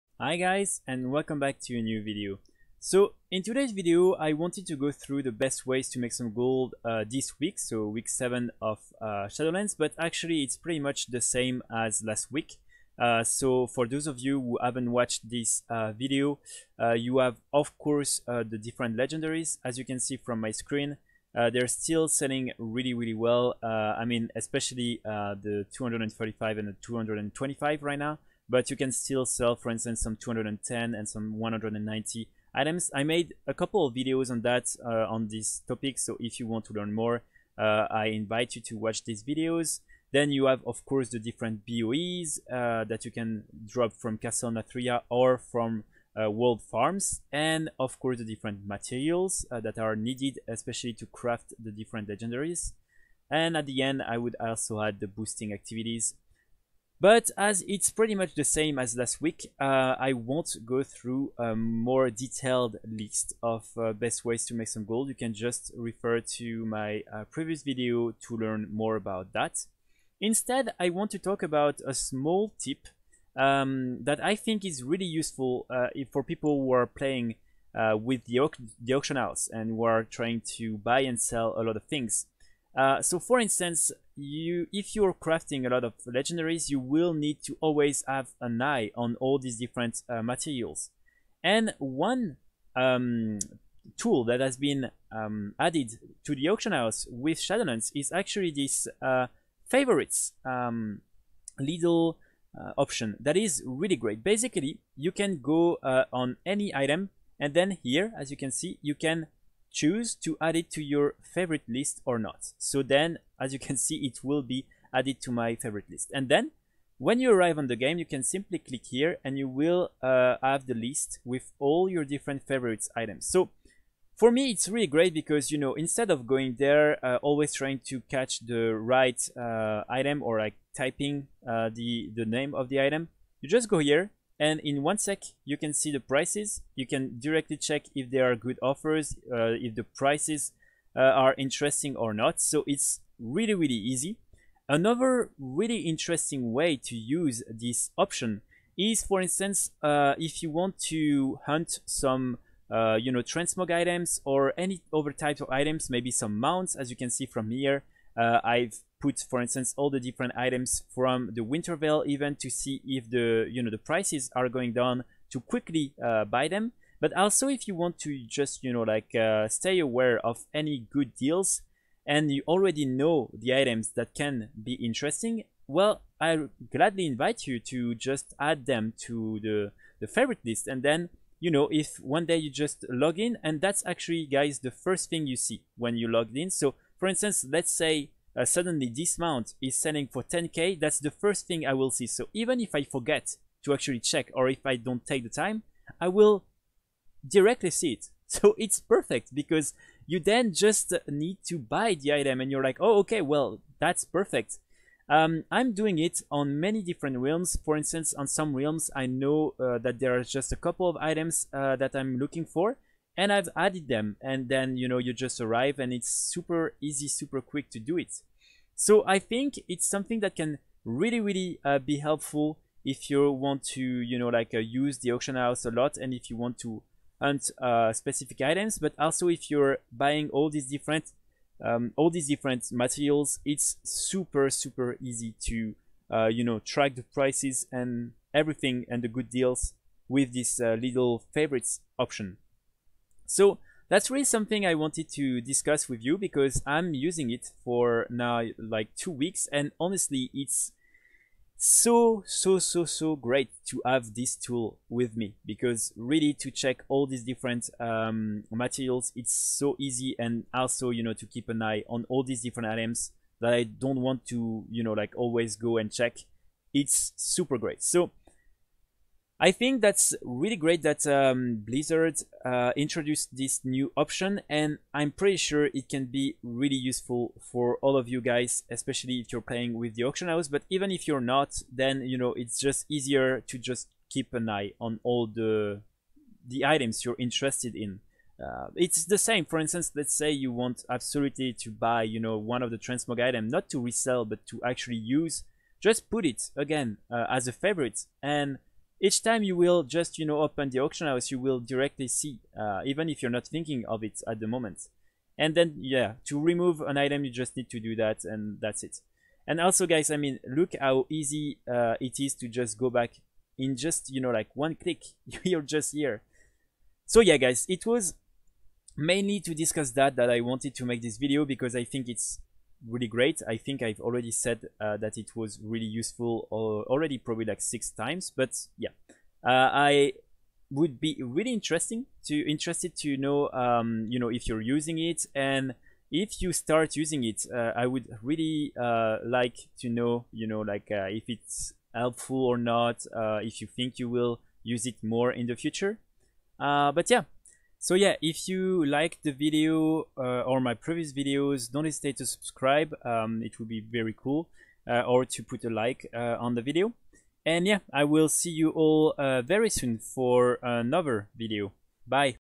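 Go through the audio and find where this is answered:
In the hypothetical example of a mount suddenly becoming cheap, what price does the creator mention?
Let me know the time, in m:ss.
3:10.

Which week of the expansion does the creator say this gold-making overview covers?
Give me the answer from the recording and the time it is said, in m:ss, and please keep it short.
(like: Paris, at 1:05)
Week 7, at 0:07.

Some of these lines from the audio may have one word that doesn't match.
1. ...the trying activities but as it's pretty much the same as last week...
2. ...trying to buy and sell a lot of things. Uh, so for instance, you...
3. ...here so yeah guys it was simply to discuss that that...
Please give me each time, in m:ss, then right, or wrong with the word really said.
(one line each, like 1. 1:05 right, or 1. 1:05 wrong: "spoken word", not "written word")
1. 0:54 wrong: "boosting", not "trying"
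2. 1:20 right
3. 5:15 wrong: "mainly", not "simply".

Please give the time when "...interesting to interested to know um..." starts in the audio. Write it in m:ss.
5:31.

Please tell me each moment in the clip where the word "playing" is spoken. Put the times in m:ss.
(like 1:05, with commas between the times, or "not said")
1:16, 4:39.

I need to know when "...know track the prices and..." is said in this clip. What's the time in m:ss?
3:56.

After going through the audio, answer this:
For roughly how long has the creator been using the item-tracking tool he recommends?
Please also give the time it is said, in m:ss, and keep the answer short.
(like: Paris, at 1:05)
2 weeks, at 4:08.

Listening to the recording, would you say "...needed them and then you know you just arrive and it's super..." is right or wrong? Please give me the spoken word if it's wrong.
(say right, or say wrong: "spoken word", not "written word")
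wrong: "added", not "needed".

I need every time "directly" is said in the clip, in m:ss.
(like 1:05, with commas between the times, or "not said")
2:17, 3:17, 5:01.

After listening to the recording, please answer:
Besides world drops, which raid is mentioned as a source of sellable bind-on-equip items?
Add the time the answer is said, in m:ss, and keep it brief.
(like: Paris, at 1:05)
Castle Nathria, at 0:44.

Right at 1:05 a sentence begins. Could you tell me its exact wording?
You can just refer to my uh, previous video to learn more about that.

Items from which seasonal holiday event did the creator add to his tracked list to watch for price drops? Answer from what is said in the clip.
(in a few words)
Winter Veil.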